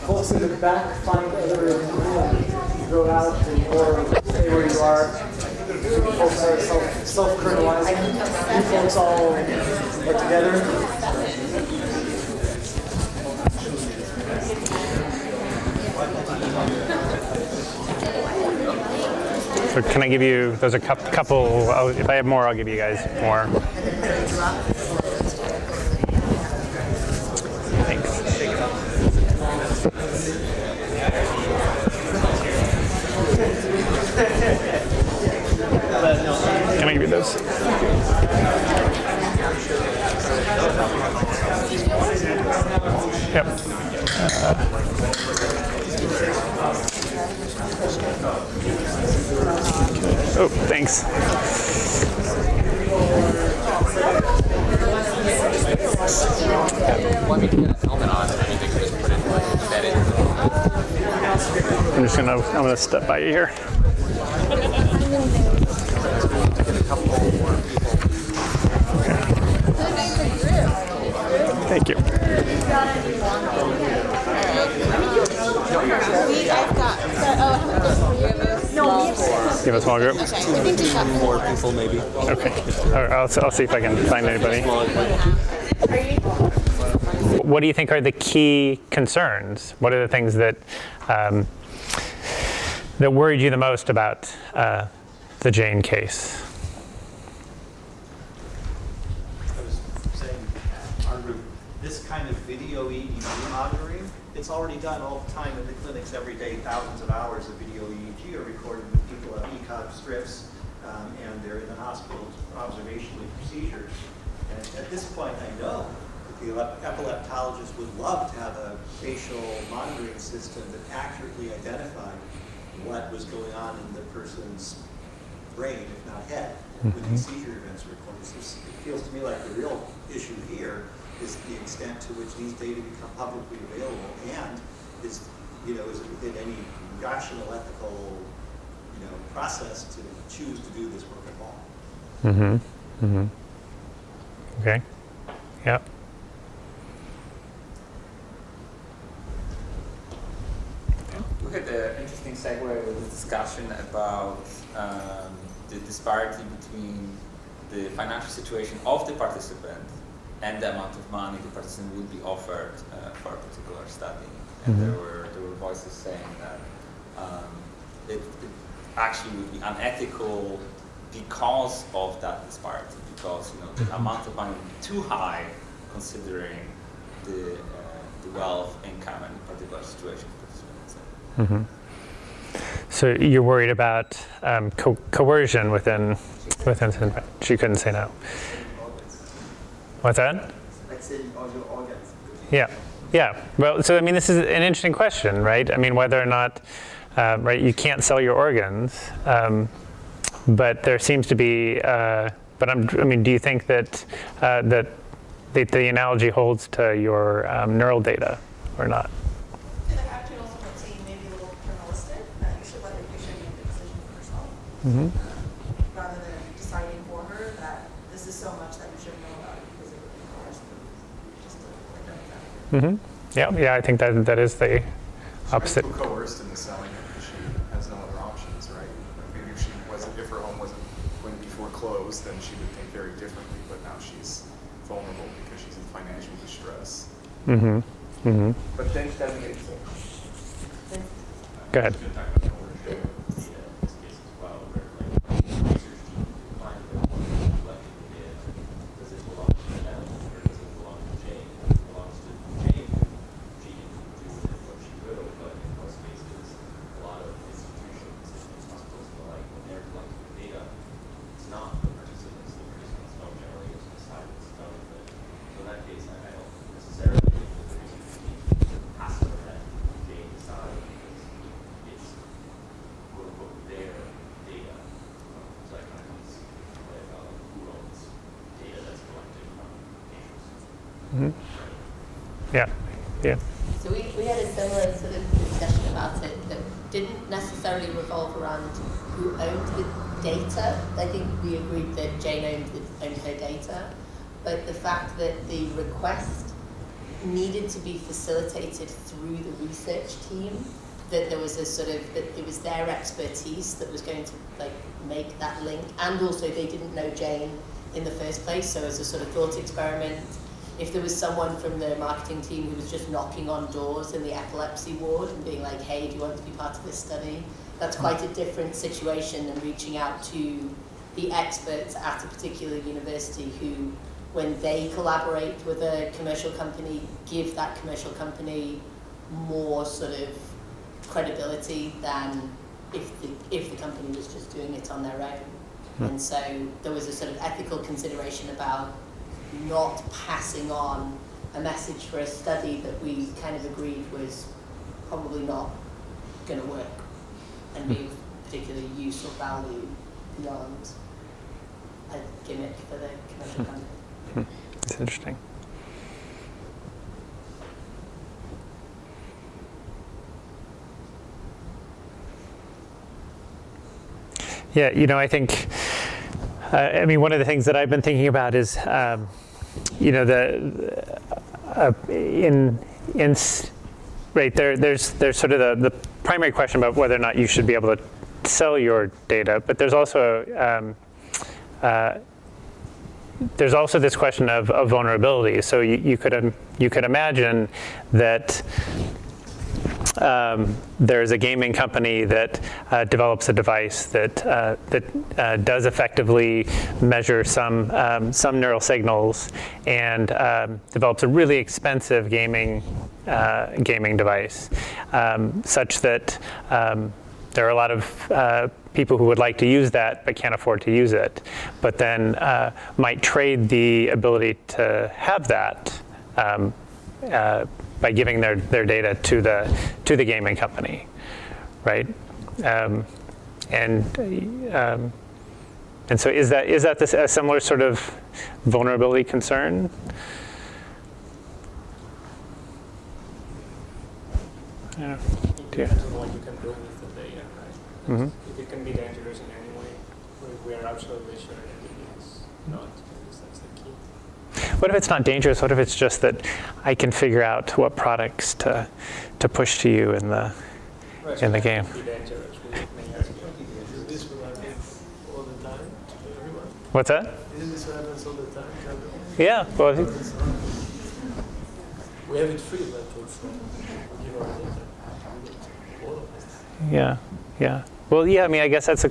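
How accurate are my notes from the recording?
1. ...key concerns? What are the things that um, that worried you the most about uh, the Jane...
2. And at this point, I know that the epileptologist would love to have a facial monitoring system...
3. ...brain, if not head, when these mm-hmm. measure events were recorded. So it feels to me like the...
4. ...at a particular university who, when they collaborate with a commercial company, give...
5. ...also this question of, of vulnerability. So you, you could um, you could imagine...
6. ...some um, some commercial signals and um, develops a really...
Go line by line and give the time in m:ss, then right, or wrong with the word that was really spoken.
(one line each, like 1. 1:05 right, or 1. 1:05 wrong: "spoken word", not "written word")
1. 1:28 right
2. 1:54 right
3. 2:05 wrong: "seizure", not "measure"
4. 5:21 right
5. 6:23 right
6. 6:37 wrong: "neural", not "commercial".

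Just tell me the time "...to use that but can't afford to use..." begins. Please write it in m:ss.
6:49.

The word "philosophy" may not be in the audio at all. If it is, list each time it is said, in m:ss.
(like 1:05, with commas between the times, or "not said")
not said.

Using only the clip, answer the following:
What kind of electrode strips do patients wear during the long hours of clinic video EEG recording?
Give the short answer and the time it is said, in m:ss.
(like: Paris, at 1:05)
ECOG strips, at 1:49.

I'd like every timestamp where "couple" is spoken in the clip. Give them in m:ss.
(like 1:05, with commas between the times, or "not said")
0:20, 1:06.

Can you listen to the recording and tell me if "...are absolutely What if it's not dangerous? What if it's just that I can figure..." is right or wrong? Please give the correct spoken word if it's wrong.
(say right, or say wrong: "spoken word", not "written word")
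right.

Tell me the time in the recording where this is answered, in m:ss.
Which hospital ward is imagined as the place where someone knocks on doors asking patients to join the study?
5:14.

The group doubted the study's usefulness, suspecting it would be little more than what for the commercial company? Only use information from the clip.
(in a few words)
a gimmick.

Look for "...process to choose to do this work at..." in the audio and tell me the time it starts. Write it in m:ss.
2:19.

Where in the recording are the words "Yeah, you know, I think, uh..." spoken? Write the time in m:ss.
6:04.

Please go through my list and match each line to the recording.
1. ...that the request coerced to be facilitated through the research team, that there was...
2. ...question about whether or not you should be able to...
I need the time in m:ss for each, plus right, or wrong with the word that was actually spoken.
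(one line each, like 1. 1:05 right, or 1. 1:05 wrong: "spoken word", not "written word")
1. 4:55 wrong: "needed", not "coerced"
2. 6:16 right.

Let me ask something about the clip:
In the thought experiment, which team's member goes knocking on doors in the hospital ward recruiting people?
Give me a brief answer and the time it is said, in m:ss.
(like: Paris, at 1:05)
marketing team, at 5:11.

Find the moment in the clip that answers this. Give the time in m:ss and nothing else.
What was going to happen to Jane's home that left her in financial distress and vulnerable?
3:51.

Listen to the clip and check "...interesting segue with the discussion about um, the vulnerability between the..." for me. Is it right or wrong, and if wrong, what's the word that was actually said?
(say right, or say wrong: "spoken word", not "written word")
wrong: "disparity", not "vulnerability".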